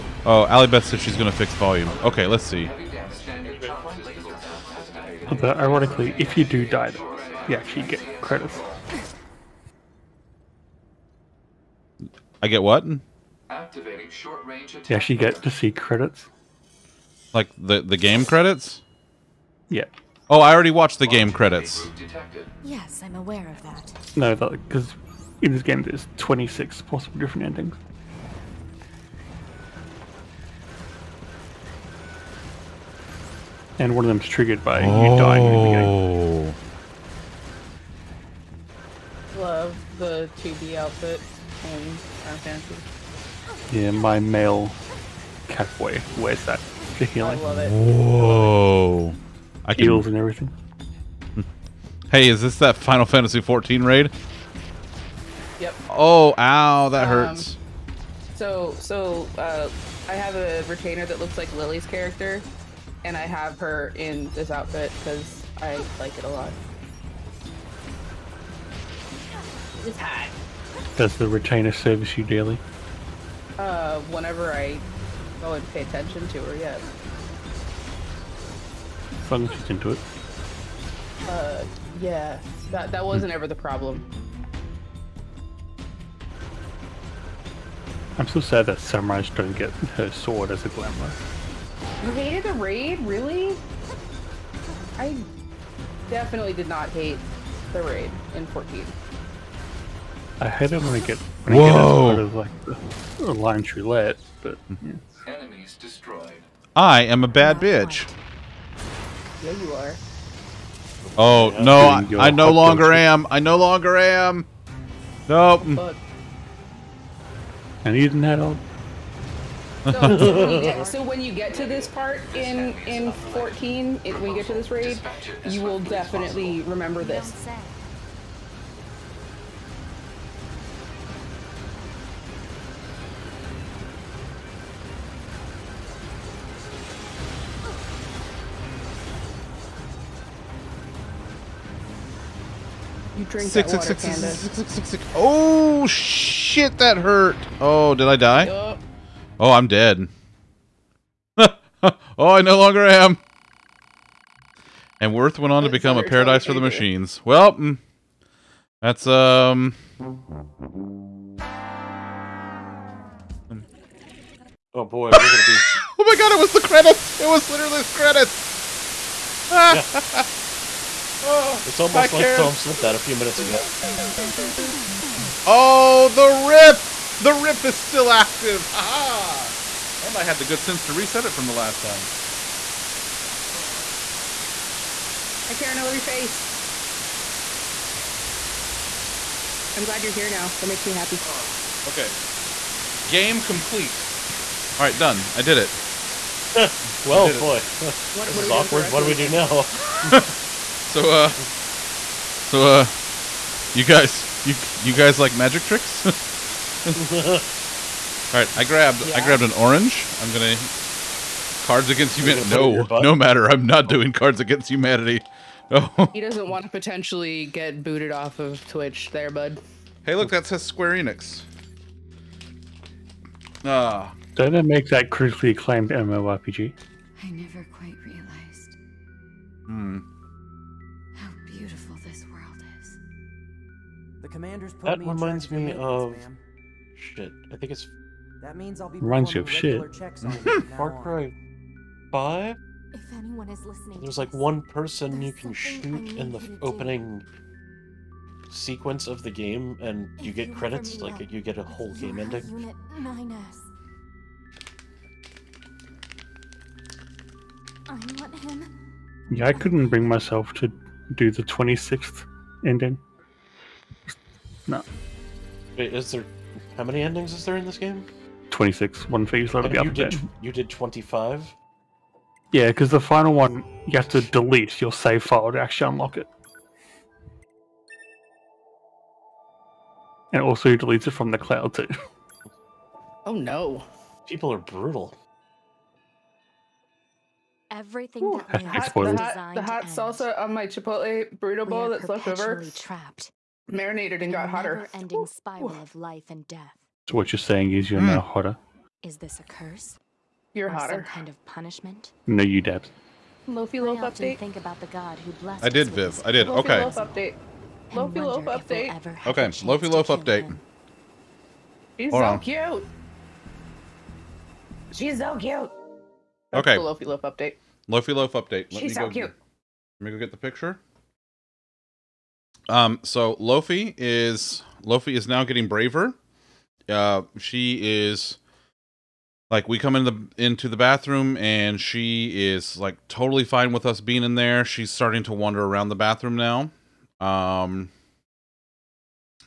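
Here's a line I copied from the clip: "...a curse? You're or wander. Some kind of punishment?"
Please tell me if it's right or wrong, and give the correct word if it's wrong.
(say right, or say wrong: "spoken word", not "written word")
wrong: "hotter", not "wander".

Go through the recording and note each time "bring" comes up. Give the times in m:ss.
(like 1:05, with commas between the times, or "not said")
4:19.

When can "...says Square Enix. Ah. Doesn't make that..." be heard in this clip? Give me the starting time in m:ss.
3:40.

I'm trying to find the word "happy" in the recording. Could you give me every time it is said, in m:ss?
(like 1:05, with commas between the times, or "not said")
3:10.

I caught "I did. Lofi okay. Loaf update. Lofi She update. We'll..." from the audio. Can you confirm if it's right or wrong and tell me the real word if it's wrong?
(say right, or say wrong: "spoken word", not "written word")
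wrong: "Loaf", not "She".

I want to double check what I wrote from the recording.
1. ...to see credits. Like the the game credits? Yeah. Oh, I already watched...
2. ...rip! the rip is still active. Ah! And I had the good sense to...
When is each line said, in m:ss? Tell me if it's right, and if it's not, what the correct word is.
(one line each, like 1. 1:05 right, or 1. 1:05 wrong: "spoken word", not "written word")
1. 0:15 right
2. 2:56 right.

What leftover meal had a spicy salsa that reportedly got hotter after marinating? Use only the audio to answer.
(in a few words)
Chipotle burrito bowl.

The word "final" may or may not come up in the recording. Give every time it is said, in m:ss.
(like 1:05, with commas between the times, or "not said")
0:42, 0:52, 4:32.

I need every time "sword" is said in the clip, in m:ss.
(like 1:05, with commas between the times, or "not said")
1:30.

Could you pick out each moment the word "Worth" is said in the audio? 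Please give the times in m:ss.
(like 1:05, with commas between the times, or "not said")
2:35.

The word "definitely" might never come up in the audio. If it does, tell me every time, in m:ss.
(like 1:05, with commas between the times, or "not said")
1:36, 2:05.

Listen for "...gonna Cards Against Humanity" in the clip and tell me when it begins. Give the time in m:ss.
3:30.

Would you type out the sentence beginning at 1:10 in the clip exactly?
Does the retainer service you daily?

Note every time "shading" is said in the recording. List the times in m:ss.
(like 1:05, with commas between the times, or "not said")
not said.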